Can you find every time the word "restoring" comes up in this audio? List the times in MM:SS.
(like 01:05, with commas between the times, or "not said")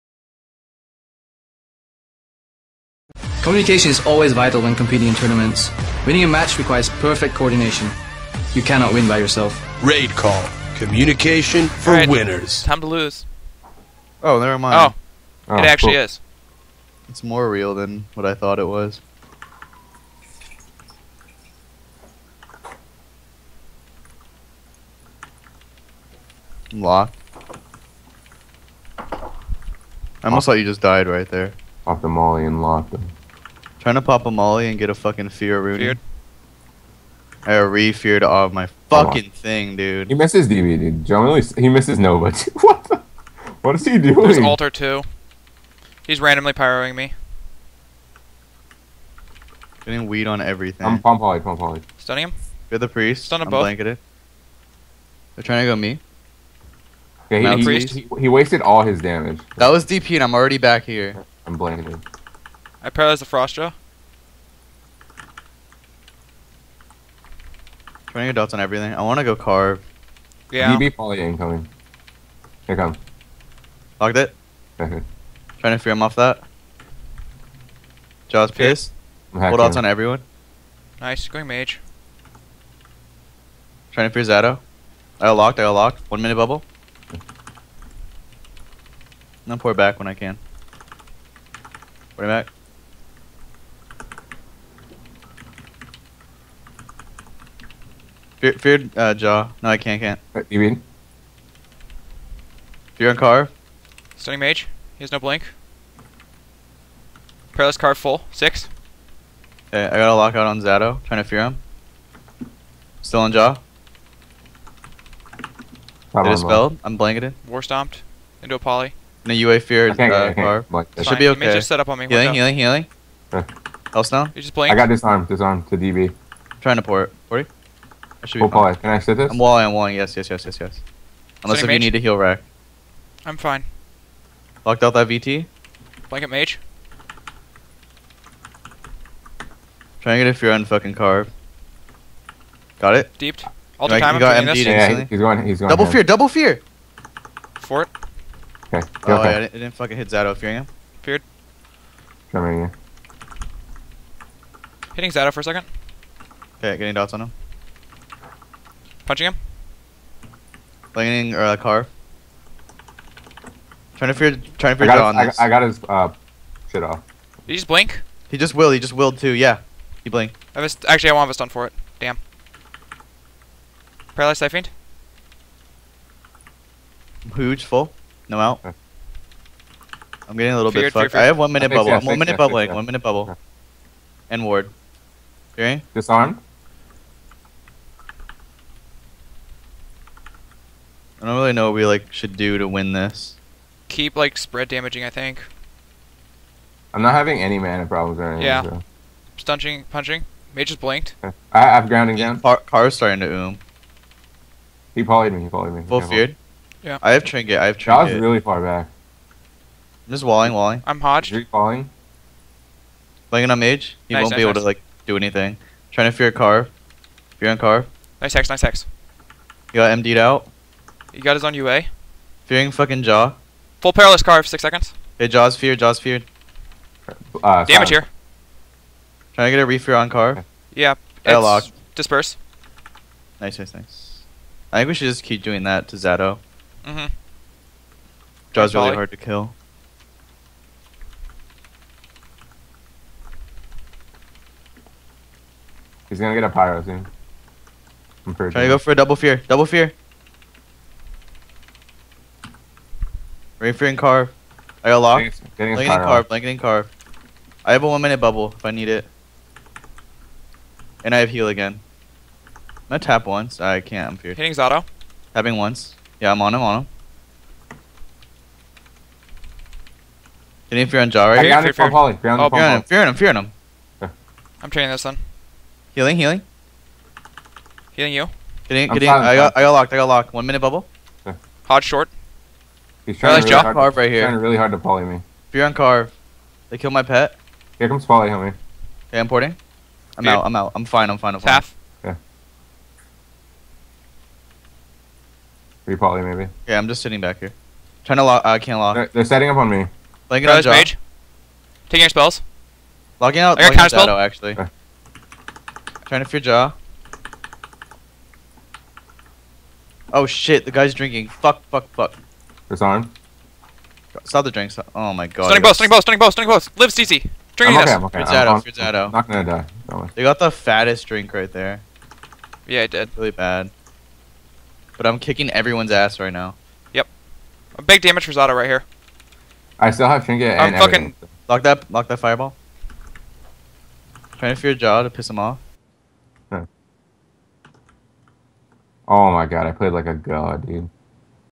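not said.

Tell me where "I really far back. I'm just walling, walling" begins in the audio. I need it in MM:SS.
03:28.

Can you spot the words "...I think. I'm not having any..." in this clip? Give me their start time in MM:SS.
03:15.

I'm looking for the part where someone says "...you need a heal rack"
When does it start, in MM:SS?
02:11.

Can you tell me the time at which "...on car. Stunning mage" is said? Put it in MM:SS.
01:43.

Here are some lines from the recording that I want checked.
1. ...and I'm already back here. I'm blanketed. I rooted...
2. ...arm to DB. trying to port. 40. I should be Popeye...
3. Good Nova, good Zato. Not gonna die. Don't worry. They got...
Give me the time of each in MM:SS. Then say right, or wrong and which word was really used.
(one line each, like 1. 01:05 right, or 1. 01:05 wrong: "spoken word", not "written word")
1. 01:00 wrong: "paralyzed", not "rooted"
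2. 02:05 right
3. 05:18 wrong: "Zato", not "Nova".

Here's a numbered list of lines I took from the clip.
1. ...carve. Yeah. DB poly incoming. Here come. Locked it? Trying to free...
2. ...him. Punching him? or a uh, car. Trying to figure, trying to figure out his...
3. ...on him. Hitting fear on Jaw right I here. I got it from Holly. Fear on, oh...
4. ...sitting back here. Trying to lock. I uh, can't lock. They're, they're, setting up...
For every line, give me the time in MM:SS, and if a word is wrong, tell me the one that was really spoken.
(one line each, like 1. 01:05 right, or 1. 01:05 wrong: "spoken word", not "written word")
1. 01:09 right
2. 02:37 right
3. 04:26 right
4. 04:57 right.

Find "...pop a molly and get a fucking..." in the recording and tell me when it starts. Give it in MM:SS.
00:34.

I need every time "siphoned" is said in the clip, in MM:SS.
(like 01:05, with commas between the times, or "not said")
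02:54.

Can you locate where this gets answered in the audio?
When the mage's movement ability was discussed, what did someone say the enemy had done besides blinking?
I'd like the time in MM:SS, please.
02:48.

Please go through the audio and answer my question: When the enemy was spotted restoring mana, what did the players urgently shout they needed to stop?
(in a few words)
The drinks.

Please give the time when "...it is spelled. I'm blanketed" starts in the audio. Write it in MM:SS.
01:56.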